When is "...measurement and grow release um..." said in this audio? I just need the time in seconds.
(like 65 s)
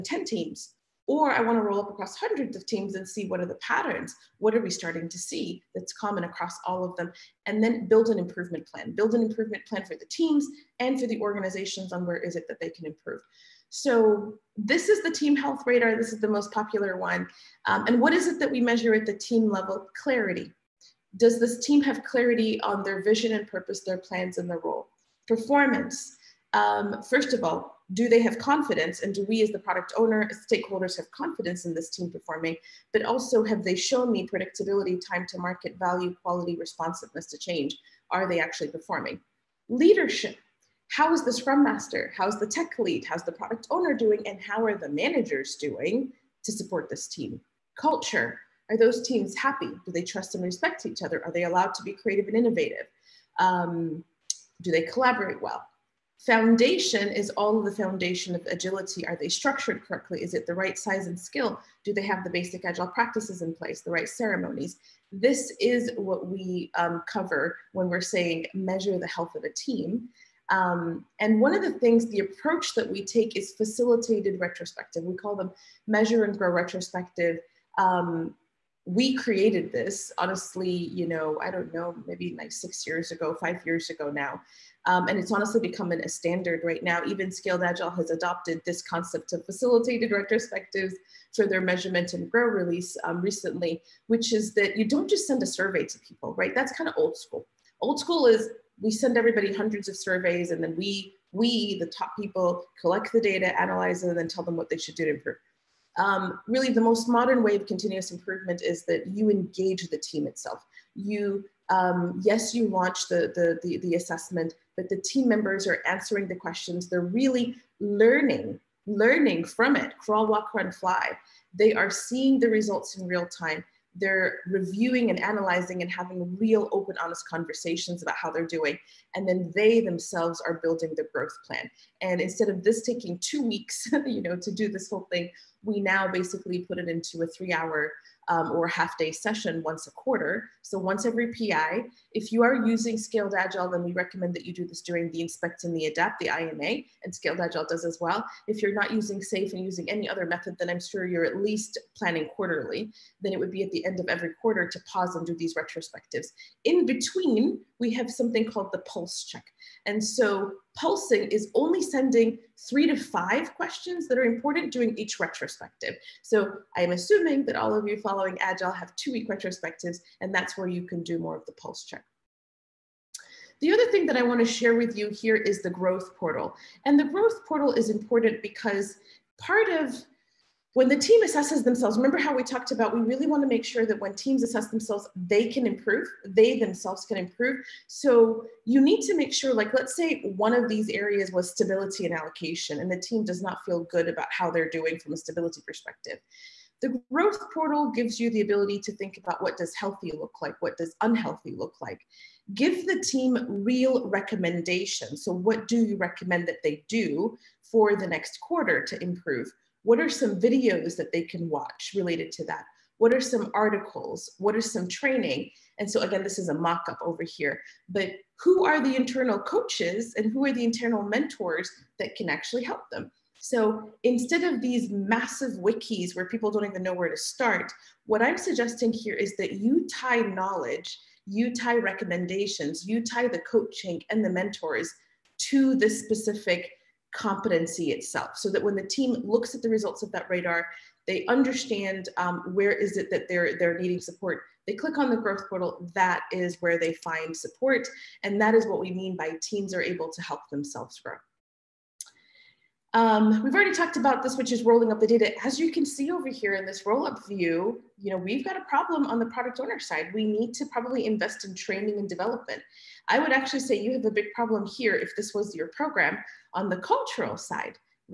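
91 s.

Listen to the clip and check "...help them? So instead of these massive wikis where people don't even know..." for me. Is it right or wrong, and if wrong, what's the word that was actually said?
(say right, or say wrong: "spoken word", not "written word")
right.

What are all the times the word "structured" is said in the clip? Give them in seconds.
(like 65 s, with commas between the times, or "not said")
59 s.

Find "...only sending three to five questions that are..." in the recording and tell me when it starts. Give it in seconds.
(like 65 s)
161 s.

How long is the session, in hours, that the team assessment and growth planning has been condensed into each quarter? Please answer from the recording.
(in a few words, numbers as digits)
3 hours.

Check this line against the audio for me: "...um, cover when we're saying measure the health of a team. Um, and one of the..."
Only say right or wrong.
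right.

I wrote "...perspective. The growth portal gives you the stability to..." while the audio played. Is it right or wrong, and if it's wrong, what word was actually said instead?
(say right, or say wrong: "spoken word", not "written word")
wrong: "ability", not "stability".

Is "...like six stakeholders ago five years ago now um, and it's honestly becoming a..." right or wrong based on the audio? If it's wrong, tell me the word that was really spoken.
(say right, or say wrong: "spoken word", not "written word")
wrong: "years", not "stakeholders".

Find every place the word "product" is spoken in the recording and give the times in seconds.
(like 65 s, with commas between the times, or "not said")
29 s, 43 s, 259 s.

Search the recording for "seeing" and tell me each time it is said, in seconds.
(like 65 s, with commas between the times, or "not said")
121 s.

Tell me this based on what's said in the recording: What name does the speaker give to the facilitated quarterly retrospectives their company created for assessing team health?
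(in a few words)
Measure and grow retrospective.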